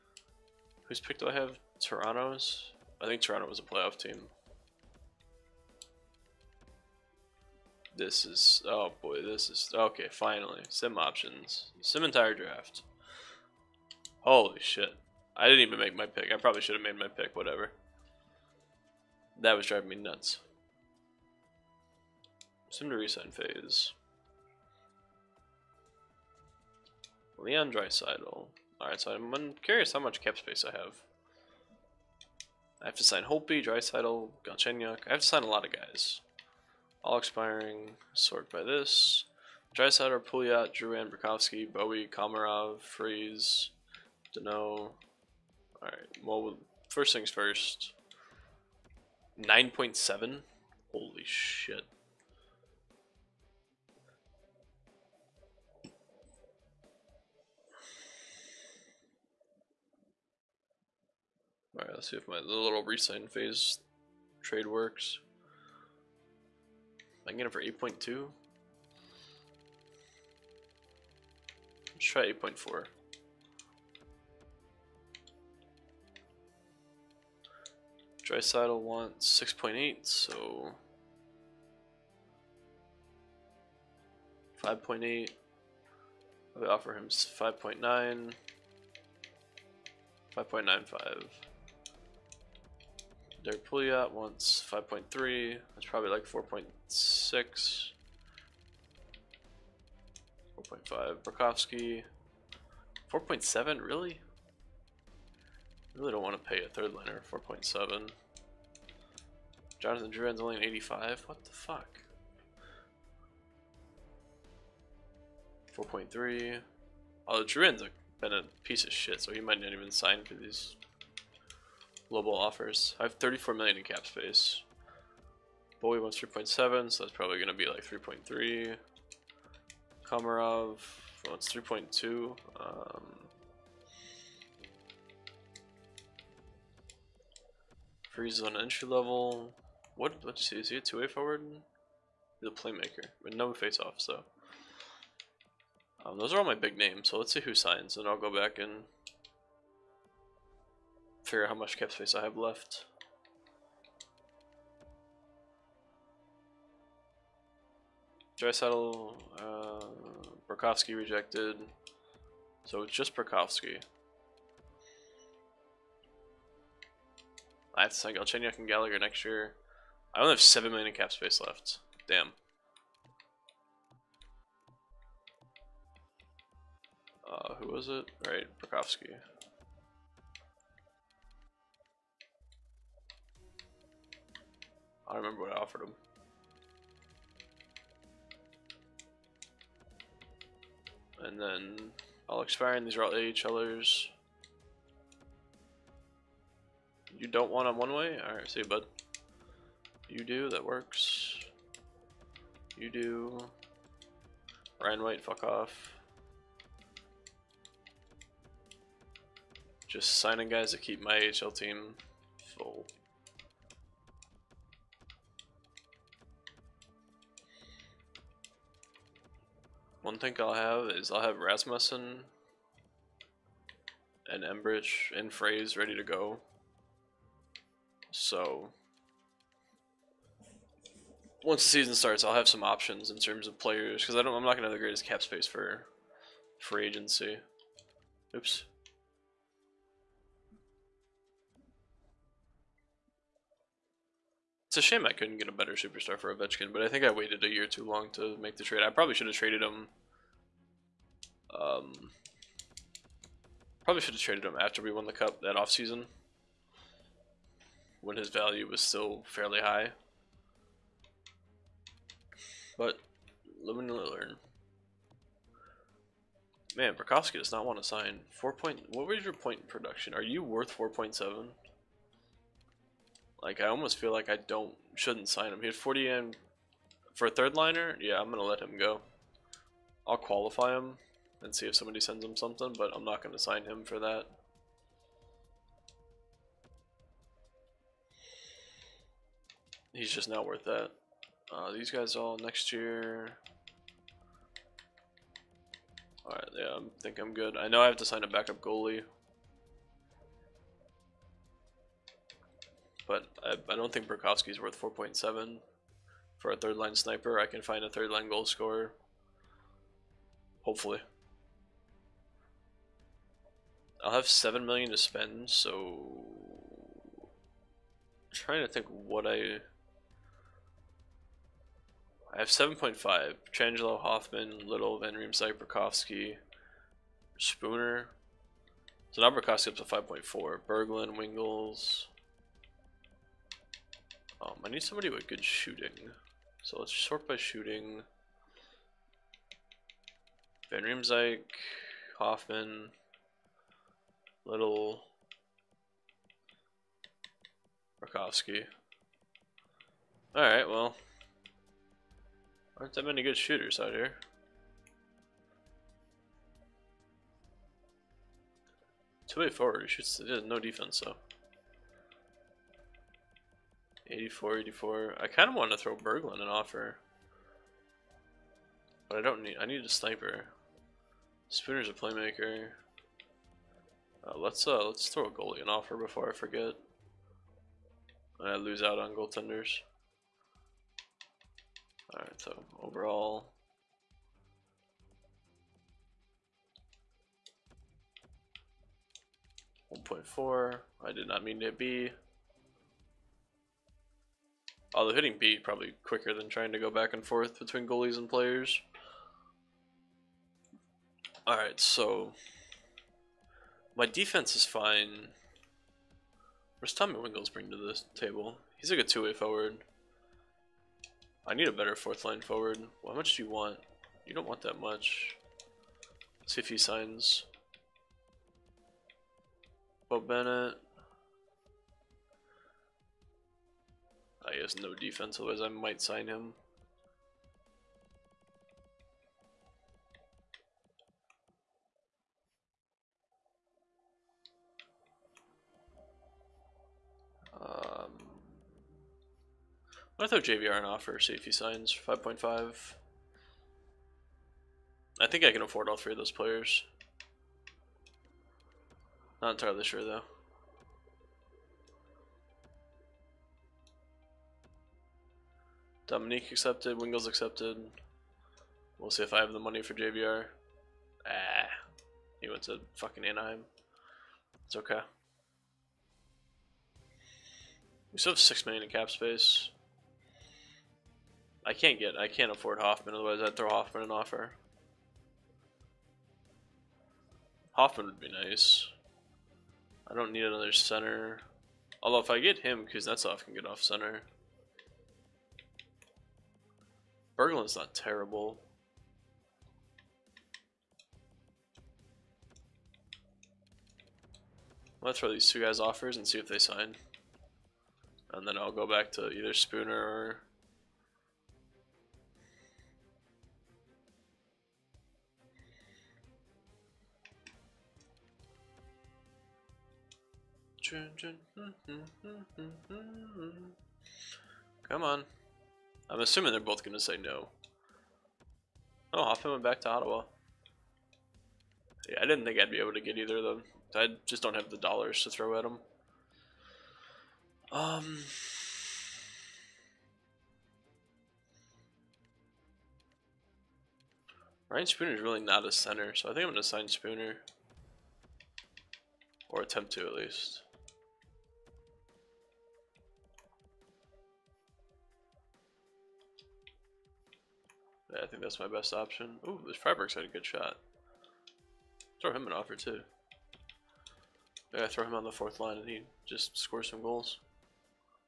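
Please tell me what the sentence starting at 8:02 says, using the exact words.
Although if I get him, Kuznetsov can get off center.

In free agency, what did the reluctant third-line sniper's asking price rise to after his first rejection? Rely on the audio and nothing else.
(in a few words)
5.4.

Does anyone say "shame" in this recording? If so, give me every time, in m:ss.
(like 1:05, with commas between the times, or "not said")
4:04.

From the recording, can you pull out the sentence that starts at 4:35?
He had forty and for a third liner.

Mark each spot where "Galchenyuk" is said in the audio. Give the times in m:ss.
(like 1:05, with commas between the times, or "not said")
0:34, 2:48.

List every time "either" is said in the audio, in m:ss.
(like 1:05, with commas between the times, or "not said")
8:19, 8:43.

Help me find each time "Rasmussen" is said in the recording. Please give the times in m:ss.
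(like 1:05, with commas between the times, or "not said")
3:41.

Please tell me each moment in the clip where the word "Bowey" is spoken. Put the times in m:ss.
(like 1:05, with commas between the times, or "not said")
0:41, 2:05.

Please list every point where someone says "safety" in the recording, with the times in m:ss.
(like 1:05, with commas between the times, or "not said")
7:21.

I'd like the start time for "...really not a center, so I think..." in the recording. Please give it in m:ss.
8:55.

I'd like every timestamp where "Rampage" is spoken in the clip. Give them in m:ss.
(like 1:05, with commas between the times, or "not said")
not said.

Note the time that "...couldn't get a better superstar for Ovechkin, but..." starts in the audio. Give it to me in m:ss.
4:05.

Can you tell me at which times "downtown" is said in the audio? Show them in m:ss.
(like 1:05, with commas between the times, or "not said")
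not said.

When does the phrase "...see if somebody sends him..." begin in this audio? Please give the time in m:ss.
4:41.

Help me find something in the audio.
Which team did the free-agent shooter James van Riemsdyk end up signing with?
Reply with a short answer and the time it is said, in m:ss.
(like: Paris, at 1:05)
Anaheim, at 7:43.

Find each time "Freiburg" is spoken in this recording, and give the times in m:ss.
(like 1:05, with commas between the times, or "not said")
9:09.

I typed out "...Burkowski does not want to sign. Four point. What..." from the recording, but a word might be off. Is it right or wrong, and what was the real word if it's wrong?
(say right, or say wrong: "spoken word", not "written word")
right.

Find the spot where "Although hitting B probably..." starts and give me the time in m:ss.
6:34.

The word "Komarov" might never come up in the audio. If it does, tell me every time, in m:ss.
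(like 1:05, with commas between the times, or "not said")
0:42, 2:10.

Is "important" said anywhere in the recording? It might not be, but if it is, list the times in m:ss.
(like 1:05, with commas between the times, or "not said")
not said.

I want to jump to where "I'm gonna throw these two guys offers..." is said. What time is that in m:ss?
8:15.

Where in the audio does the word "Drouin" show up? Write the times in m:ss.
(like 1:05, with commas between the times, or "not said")
0:40, 1:50, 1:57.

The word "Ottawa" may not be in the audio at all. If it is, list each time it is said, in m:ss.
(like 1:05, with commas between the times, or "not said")
8:39.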